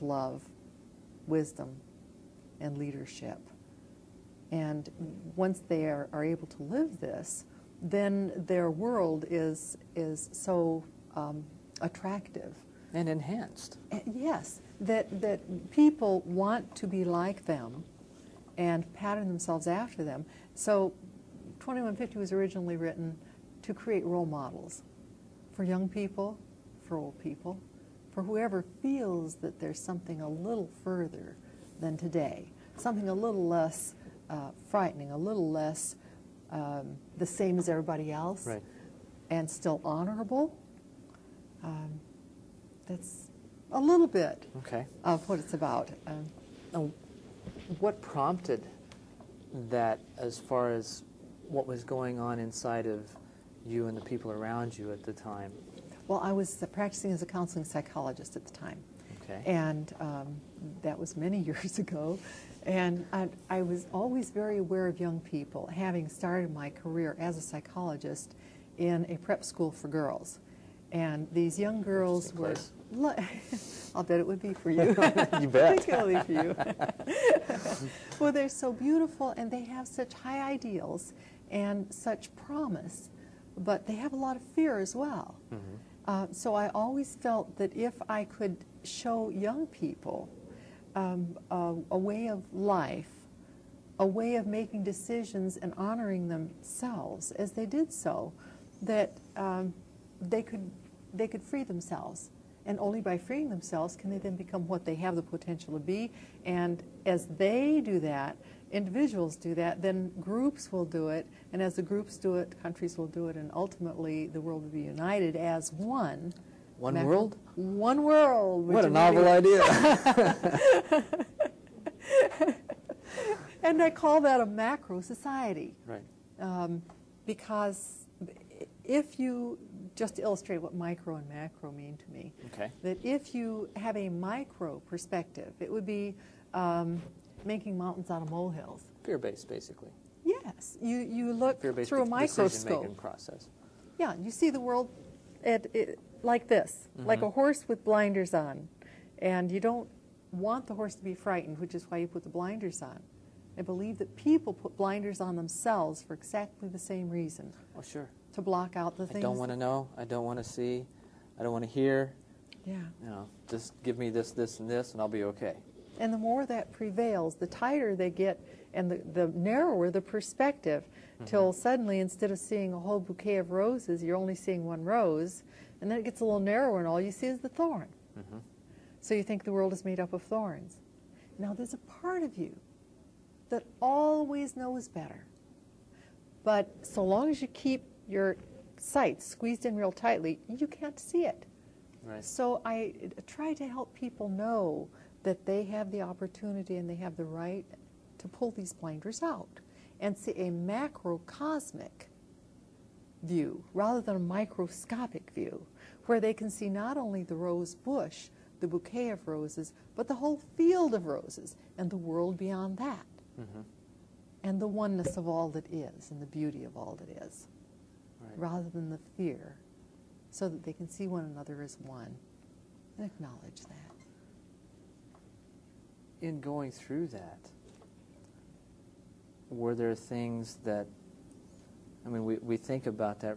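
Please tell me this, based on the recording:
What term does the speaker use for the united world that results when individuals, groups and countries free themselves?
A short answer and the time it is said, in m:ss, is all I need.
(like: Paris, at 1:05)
Macro society, at 2:04.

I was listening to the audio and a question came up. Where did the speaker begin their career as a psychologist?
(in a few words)
A prep school for girls.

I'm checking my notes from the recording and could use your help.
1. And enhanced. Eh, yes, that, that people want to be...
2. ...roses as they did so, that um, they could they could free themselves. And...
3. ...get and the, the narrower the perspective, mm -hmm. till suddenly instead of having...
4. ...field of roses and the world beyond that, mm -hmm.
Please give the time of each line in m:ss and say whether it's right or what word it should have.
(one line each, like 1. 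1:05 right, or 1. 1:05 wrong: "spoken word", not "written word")
1. 0:12 right
2. 1:36 wrong: "themselves", not "roses"
3. 2:48 wrong: "seeing", not "having"
4. 3:30 right.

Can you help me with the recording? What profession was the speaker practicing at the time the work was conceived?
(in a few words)
Counseling psychologist.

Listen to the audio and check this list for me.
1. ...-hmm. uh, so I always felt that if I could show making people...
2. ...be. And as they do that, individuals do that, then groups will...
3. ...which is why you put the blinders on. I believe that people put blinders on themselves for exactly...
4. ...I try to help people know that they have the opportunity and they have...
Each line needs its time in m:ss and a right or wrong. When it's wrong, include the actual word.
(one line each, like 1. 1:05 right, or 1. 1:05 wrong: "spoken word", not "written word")
1. 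1:25 wrong: "young", not "making"
2. 1:45 right
3. 2:31 right
4. 3:12 right.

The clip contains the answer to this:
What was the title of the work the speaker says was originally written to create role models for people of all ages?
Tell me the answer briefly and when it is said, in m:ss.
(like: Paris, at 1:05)
2150, at 0:21.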